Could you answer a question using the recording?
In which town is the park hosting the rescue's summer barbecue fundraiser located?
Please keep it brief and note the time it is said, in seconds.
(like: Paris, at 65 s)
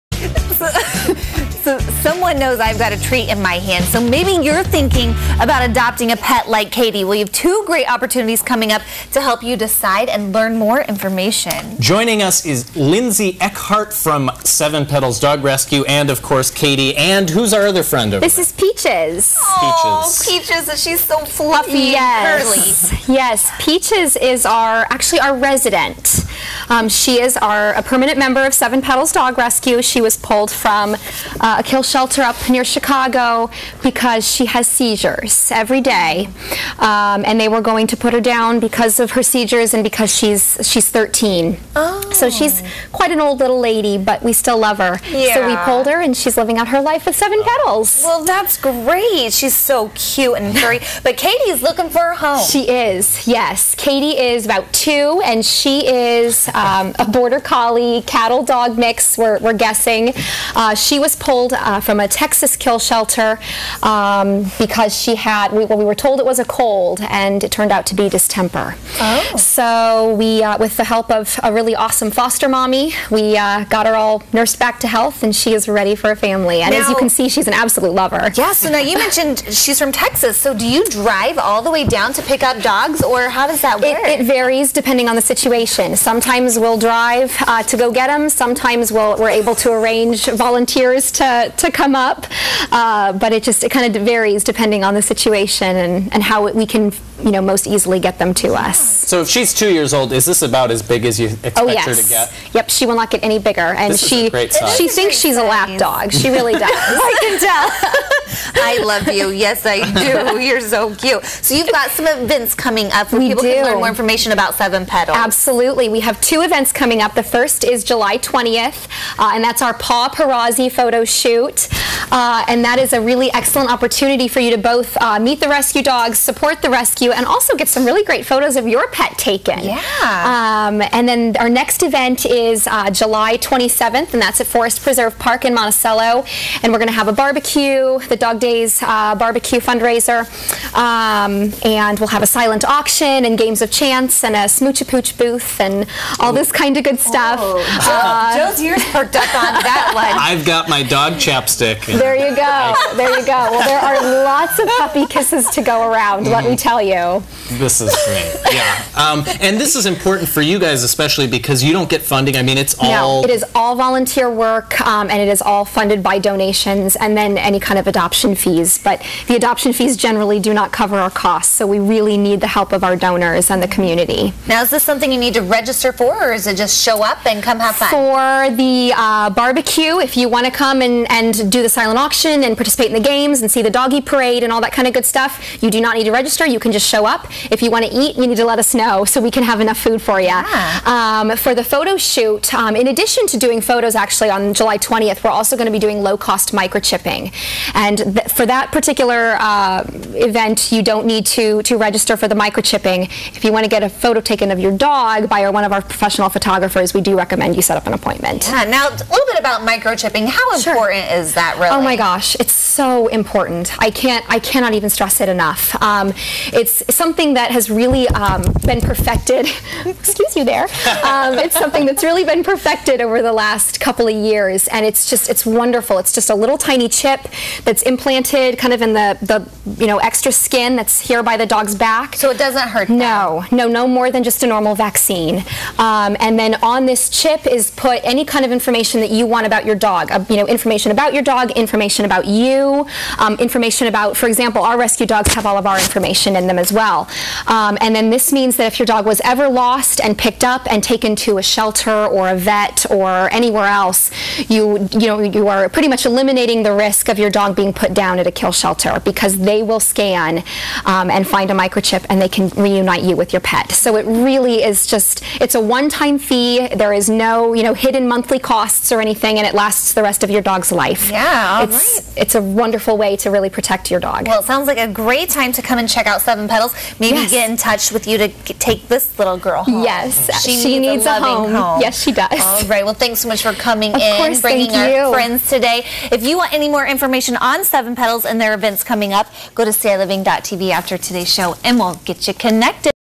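Monticello, at 135 s.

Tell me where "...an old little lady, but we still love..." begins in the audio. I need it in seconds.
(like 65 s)
43 s.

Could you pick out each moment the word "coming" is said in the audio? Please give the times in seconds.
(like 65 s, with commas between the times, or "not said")
8 s, 112 s, 116 s, 283 s, 288 s.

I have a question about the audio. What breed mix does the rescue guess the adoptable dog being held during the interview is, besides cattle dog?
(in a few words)
Border collie.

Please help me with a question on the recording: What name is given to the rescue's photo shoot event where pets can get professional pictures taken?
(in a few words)
Paw Parazzi.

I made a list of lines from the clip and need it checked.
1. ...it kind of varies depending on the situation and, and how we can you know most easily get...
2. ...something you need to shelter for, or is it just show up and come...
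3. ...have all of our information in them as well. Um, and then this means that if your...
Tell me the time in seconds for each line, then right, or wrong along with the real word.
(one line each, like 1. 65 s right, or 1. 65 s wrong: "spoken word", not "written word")
1. 93 s right
2. 174 s wrong: "register", not "shelter"
3. 245 s right.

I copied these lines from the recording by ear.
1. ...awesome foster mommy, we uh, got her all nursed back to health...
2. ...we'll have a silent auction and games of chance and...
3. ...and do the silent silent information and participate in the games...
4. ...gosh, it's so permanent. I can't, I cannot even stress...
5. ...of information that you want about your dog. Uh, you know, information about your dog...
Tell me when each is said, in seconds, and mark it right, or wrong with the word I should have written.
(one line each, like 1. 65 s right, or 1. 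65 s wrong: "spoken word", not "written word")
1. 71 s right
2. 141 s right
3. 181 s wrong: "auction", not "information"
4. 211 s wrong: "important", not "permanent"
5. 238 s right.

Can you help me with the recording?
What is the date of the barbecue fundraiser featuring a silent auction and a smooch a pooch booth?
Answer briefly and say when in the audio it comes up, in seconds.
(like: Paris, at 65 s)
July 27th, at 132 s.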